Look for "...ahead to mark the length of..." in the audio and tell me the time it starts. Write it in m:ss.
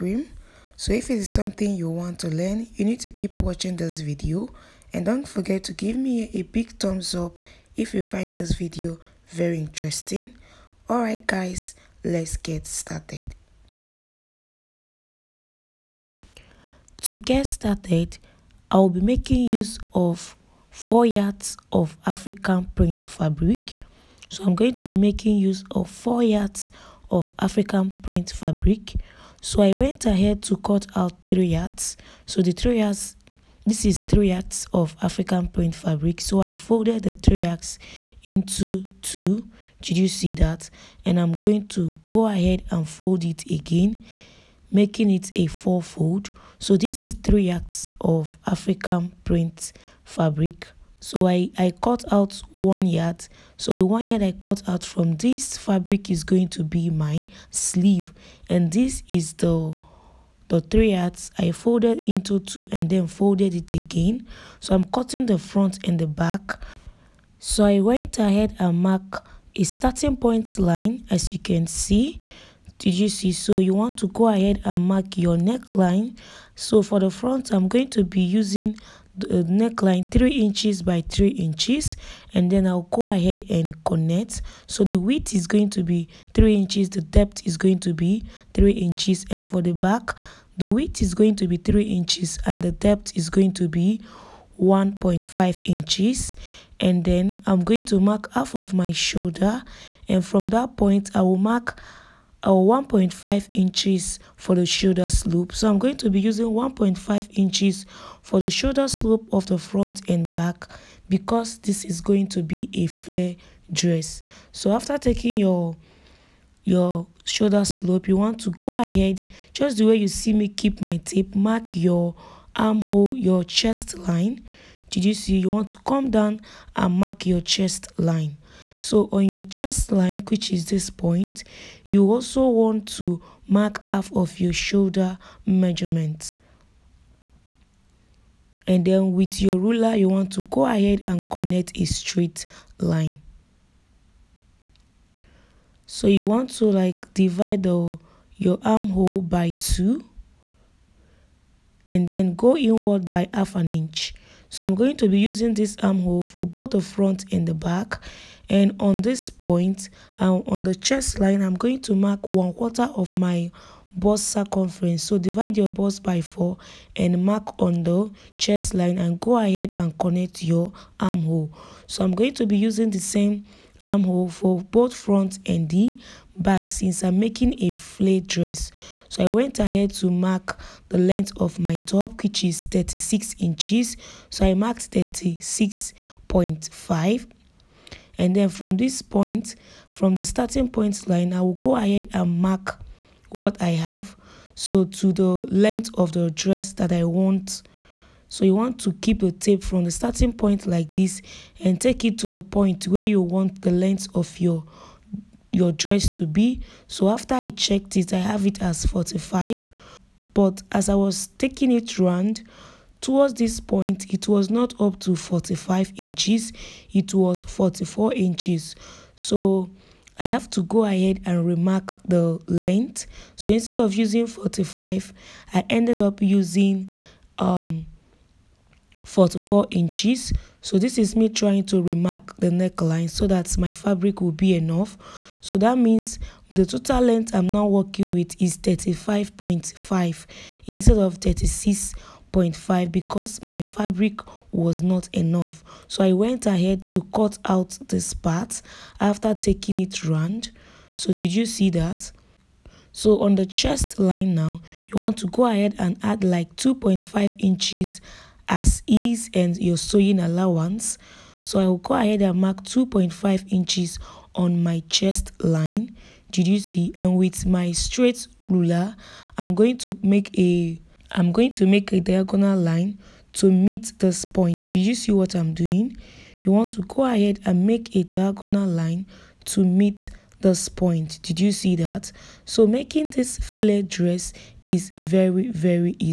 2:59.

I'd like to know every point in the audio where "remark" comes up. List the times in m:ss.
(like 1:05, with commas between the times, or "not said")
3:41, 3:51.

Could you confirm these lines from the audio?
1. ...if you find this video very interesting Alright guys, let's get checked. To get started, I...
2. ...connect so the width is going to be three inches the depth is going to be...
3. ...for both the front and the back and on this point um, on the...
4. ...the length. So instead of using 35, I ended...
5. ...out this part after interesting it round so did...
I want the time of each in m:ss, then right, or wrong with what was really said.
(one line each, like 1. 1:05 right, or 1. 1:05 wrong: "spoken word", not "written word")
1. 0:07 wrong: "started", not "checked"
2. 1:23 right
3. 2:36 right
4. 3:42 wrong: "45", not "35"
5. 4:07 wrong: "taking", not "interesting".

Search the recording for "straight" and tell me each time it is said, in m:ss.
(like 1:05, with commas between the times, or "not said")
2:21, 4:27.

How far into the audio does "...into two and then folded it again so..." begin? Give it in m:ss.
1:02.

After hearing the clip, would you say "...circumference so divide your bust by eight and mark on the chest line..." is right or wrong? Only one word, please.
wrong.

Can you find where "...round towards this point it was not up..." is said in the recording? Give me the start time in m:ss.
3:31.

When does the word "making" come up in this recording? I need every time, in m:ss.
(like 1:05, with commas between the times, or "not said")
0:18, 0:24, 0:44, 2:57, 4:42.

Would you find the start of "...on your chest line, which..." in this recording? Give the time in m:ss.
2:09.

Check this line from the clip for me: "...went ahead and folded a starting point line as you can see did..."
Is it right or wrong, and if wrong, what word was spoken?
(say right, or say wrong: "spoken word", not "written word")
wrong: "marked", not "folded".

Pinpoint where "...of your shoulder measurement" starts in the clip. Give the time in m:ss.
2:14.